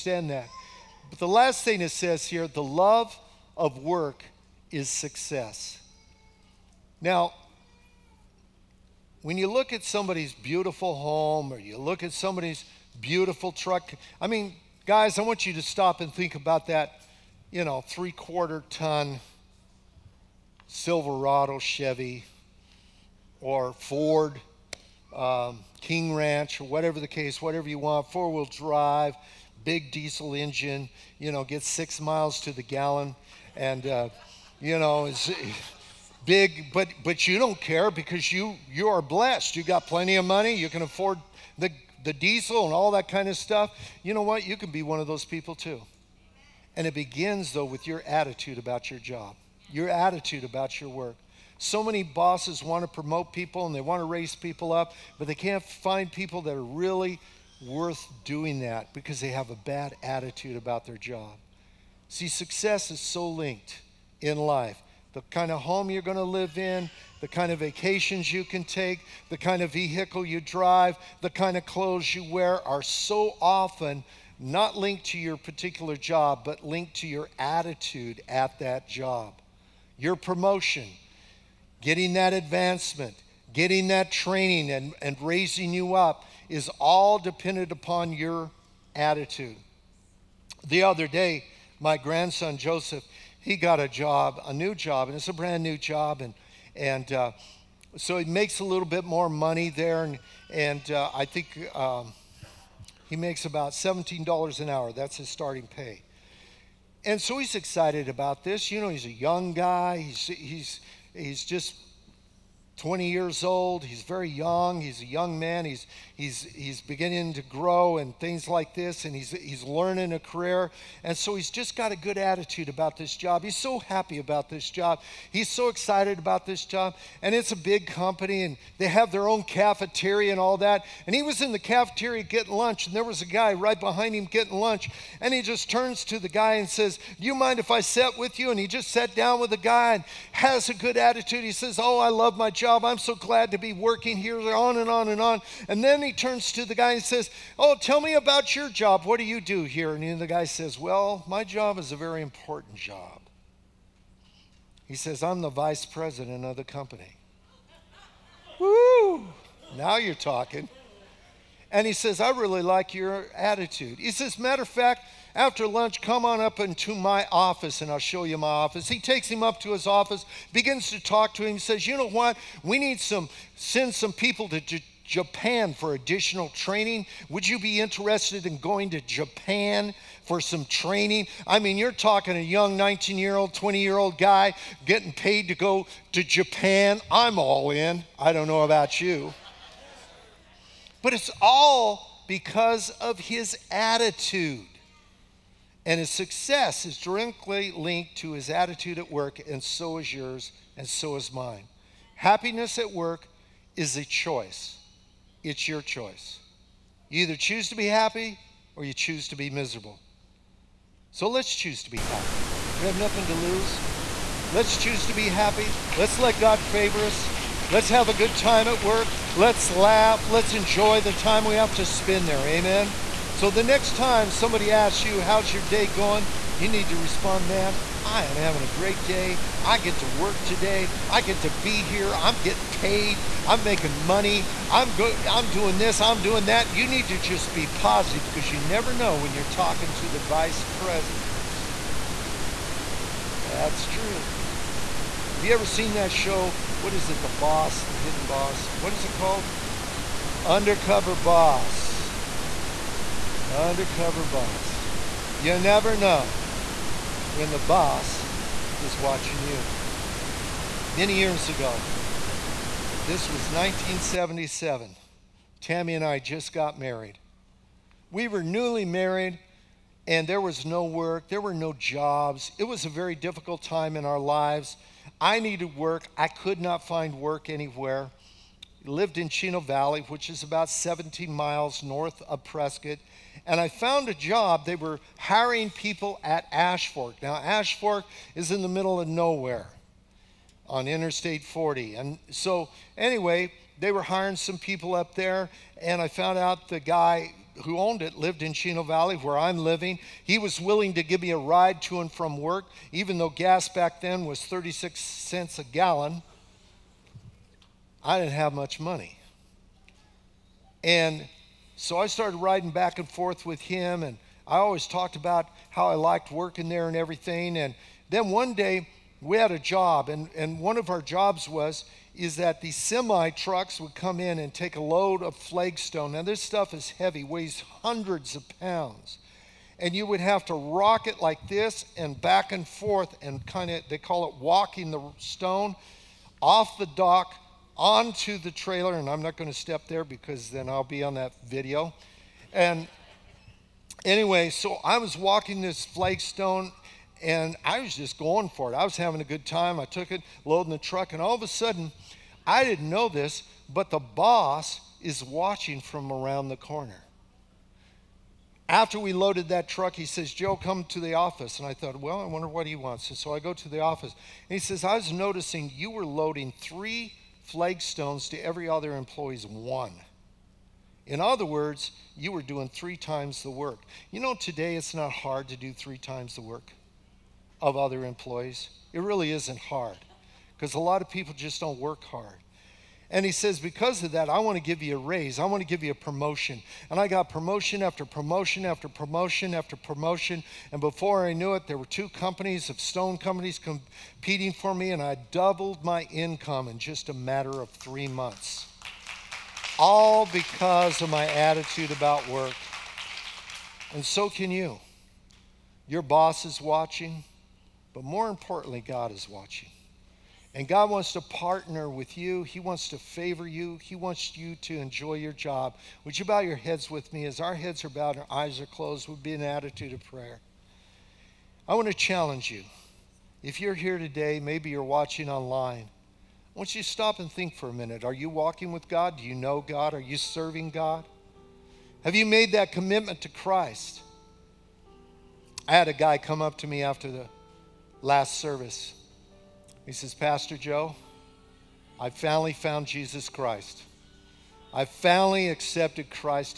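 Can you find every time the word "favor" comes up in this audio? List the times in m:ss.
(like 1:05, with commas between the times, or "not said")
3:36, 6:52.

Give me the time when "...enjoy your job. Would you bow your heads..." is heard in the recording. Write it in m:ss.
6:54.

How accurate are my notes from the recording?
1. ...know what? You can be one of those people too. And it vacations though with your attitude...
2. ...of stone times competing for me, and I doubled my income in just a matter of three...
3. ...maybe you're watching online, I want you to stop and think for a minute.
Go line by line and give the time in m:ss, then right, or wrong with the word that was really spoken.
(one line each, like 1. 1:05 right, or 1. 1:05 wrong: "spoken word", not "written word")
1. 0:44 wrong: "begins", not "vacations"
2. 6:32 wrong: "companies", not "times"
3. 7:04 right.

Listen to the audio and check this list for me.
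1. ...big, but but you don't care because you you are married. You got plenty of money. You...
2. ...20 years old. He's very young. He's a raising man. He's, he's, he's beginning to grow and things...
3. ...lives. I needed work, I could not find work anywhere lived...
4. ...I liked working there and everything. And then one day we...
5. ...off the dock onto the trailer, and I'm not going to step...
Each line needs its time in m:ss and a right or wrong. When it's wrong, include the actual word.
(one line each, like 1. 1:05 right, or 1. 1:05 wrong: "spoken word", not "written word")
1. 0:36 wrong: "blessed", not "married"
2. 1:52 wrong: "young", not "raising"
3. 4:34 right
4. 5:15 right
5. 5:36 right.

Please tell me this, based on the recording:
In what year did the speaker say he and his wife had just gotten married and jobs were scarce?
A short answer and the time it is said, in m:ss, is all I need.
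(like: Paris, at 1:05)
1977, at 4:23.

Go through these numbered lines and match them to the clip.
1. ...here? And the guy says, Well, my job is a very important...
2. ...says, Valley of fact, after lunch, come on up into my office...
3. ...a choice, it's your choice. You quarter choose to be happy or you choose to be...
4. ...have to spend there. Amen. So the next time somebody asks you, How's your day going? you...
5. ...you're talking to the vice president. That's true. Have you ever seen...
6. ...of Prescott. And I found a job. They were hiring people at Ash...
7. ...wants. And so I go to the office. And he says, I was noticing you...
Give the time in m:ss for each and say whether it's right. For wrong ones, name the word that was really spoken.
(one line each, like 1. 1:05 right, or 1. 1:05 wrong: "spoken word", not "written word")
1. 2:29 right
2. 2:44 wrong: "Matter", not "Valley"
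3. 3:23 wrong: "either", not "quarter"
4. 3:41 right
5. 3:59 right
6. 4:42 right
7. 6:02 right.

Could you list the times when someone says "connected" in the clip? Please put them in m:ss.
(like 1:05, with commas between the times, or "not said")
not said.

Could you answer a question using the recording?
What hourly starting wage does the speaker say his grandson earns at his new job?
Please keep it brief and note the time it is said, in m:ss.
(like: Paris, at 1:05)
$17, at 1:43.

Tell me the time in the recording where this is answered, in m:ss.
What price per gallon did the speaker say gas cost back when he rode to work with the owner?
5:04.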